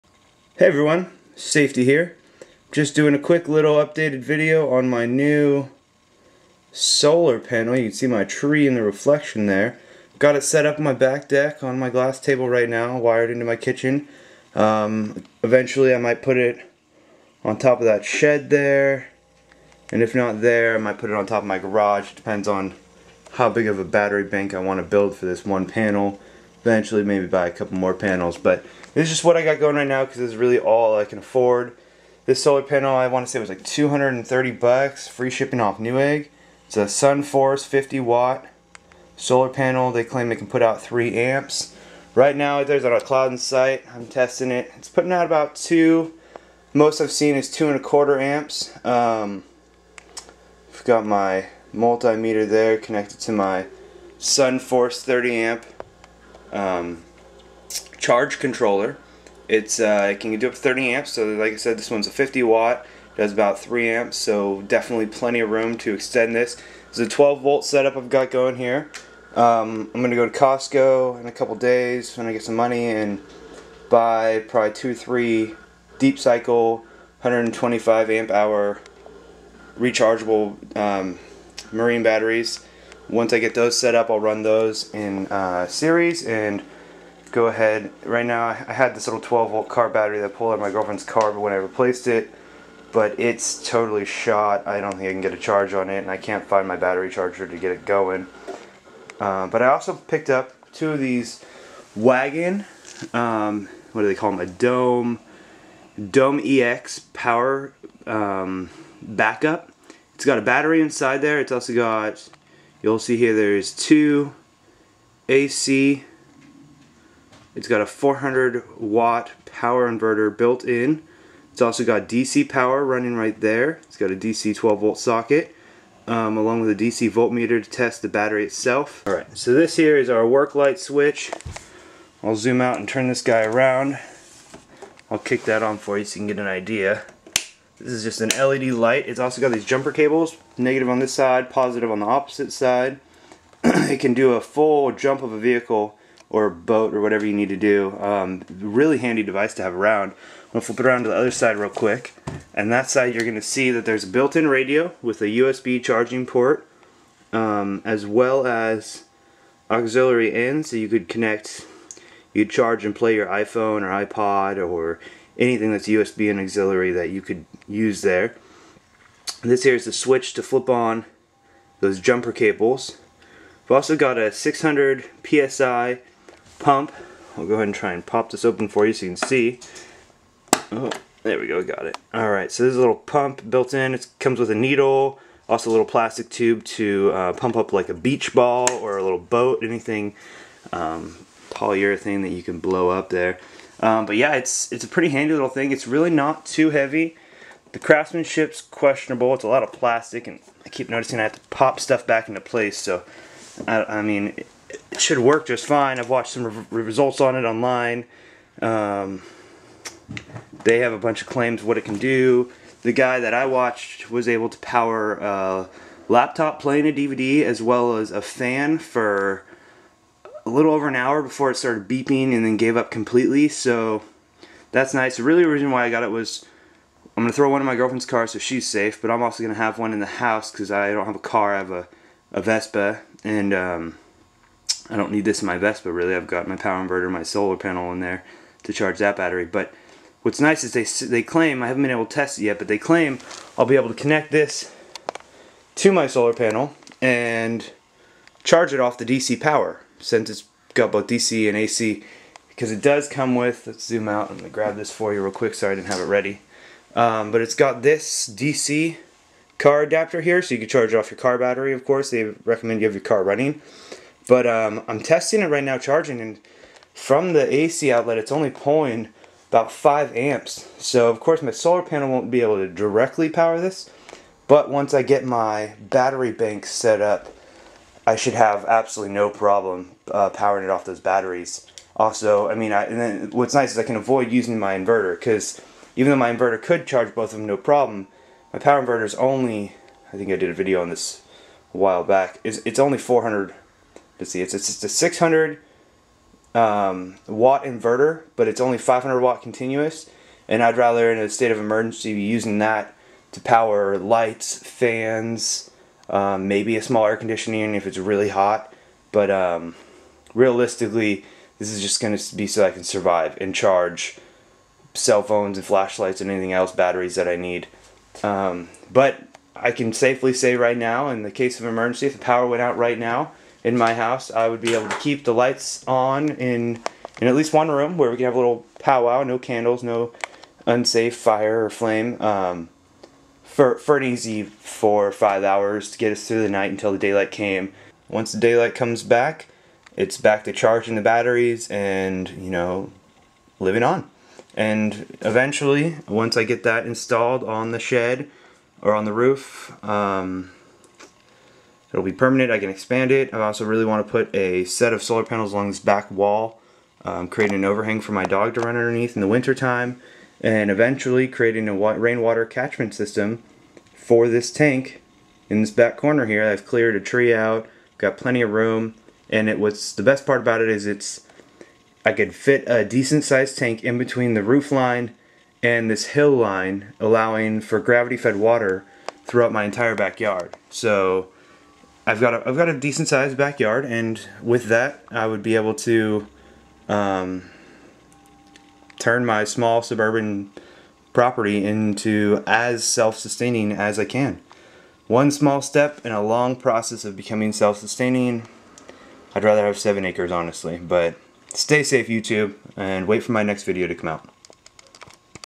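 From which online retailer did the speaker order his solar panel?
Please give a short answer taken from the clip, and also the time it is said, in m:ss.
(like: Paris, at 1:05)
Newegg, at 0:35.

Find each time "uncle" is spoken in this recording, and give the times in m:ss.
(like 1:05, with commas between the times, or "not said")
not said.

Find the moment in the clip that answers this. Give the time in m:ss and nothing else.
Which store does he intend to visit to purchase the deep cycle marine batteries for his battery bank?
1:10.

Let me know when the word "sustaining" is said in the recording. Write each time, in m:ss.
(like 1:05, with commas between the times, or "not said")
6:32, 6:37.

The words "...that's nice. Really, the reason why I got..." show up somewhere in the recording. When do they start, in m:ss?
3:44.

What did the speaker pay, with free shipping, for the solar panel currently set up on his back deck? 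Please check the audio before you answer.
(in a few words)
$230.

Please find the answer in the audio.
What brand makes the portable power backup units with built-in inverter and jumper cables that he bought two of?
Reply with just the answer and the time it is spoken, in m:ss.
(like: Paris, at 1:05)
WAGAN, at 1:41.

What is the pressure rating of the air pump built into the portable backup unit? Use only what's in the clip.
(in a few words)
600 psi.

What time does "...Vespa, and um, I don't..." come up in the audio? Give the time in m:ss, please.
3:52.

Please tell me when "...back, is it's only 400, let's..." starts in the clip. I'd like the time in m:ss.
4:52.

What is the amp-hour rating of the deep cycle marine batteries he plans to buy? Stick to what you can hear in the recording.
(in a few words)
125 amp hour.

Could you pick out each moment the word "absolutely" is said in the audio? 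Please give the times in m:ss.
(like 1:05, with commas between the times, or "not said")
4:38.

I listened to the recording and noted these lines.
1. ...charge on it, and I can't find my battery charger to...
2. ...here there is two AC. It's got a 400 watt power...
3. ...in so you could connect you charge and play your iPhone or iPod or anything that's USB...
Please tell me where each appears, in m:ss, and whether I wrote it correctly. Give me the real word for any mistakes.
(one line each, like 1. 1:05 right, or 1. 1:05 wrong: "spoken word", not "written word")
1. 1:35 right
2. 1:53 right
3. 2:40 right.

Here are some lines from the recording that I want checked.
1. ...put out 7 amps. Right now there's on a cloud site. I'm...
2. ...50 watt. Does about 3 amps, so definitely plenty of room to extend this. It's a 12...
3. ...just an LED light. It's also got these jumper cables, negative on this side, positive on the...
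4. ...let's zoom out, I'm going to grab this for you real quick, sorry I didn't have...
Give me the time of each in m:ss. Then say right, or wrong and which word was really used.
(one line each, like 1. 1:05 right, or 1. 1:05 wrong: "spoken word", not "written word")
1. 0:40 wrong: "3", not "7"
2. 1:02 right
3. 2:18 right
4. 4:13 right.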